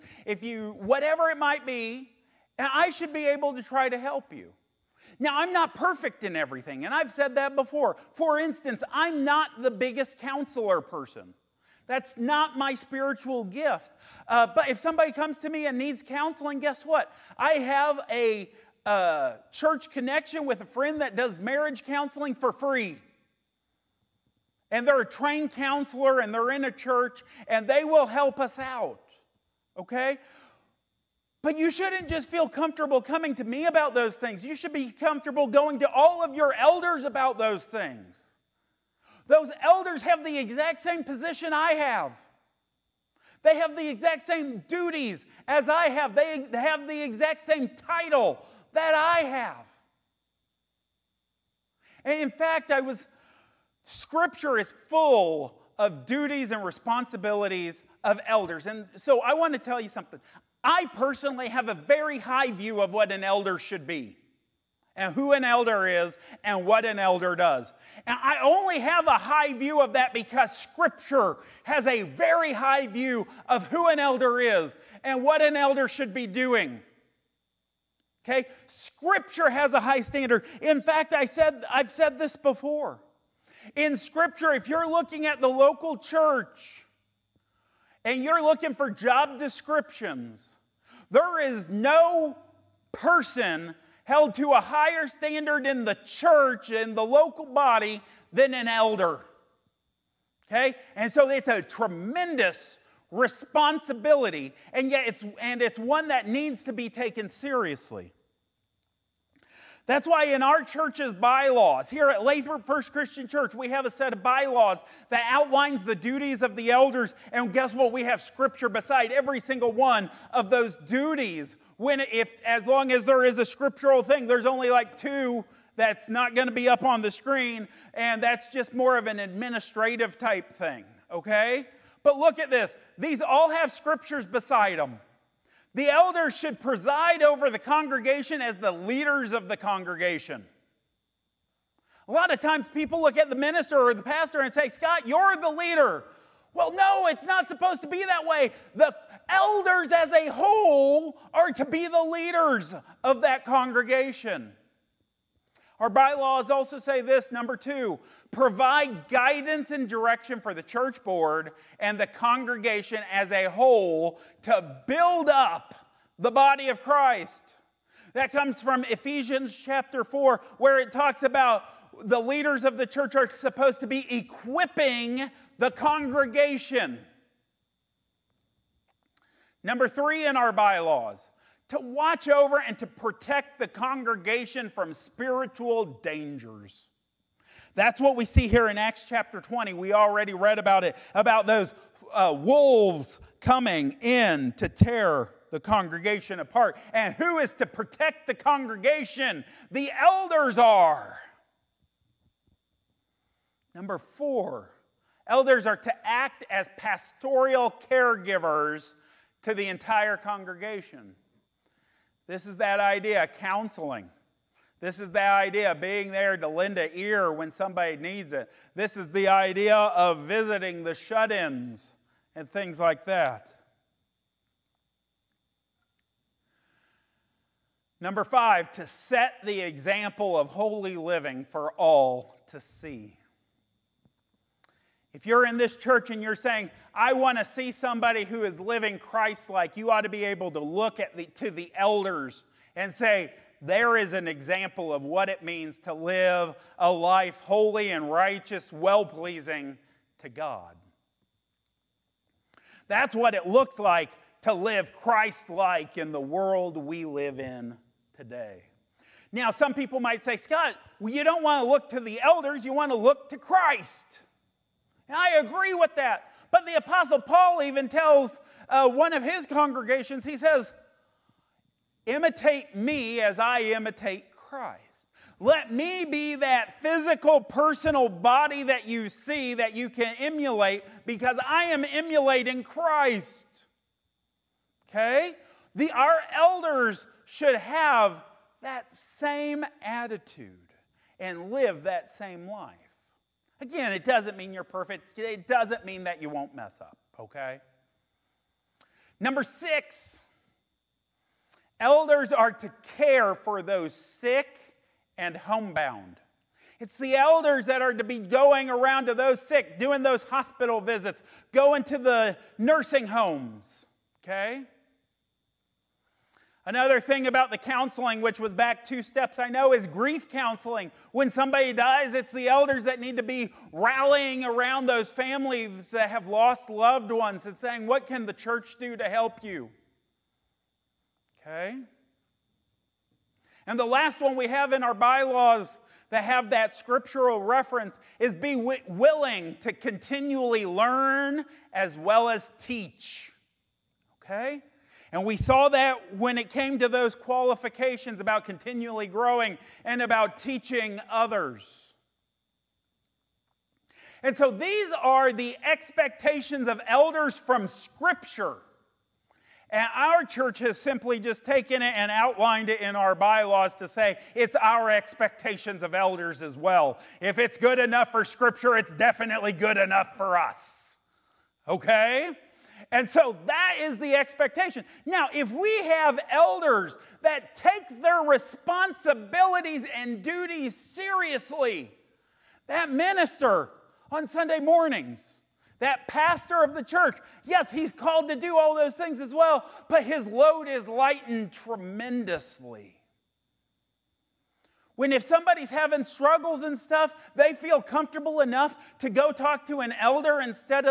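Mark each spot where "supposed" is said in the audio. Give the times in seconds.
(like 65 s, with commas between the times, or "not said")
147 s, 173 s.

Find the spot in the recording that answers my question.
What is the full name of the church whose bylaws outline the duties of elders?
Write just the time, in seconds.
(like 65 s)
112 s.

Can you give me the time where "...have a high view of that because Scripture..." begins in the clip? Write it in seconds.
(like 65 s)
68 s.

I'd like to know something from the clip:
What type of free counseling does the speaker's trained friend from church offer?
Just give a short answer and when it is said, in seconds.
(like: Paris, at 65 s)
Marriage counseling, at 21 s.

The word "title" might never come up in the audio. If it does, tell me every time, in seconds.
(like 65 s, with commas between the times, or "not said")
47 s.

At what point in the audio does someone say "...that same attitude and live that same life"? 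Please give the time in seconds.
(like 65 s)
288 s.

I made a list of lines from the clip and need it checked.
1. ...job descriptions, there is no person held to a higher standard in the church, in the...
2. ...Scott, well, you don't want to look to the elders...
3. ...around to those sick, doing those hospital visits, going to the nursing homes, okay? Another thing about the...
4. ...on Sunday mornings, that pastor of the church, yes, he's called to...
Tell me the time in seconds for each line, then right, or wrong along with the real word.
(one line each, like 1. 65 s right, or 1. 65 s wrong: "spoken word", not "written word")
1. 88 s right
2. 260 s right
3. 308 s right
4. 384 s right.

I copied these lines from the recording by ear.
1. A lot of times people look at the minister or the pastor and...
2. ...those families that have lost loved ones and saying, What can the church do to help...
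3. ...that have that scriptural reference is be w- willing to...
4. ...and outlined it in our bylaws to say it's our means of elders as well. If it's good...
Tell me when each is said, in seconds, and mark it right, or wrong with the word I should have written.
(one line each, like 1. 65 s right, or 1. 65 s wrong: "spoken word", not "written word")
1. 142 s right
2. 324 s right
3. 336 s right
4. 361 s wrong: "expectations", not "means".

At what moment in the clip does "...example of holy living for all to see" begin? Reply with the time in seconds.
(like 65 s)
229 s.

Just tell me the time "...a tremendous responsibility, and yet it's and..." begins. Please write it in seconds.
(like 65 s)
101 s.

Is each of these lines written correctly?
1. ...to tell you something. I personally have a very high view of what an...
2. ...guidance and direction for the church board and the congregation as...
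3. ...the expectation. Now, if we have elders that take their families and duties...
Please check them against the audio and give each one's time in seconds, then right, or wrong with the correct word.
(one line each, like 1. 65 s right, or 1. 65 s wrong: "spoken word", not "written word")
1. 59 s right
2. 159 s right
3. 373 s wrong: "responsibilities", not "families".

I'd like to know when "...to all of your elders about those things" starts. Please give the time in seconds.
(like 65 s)
35 s.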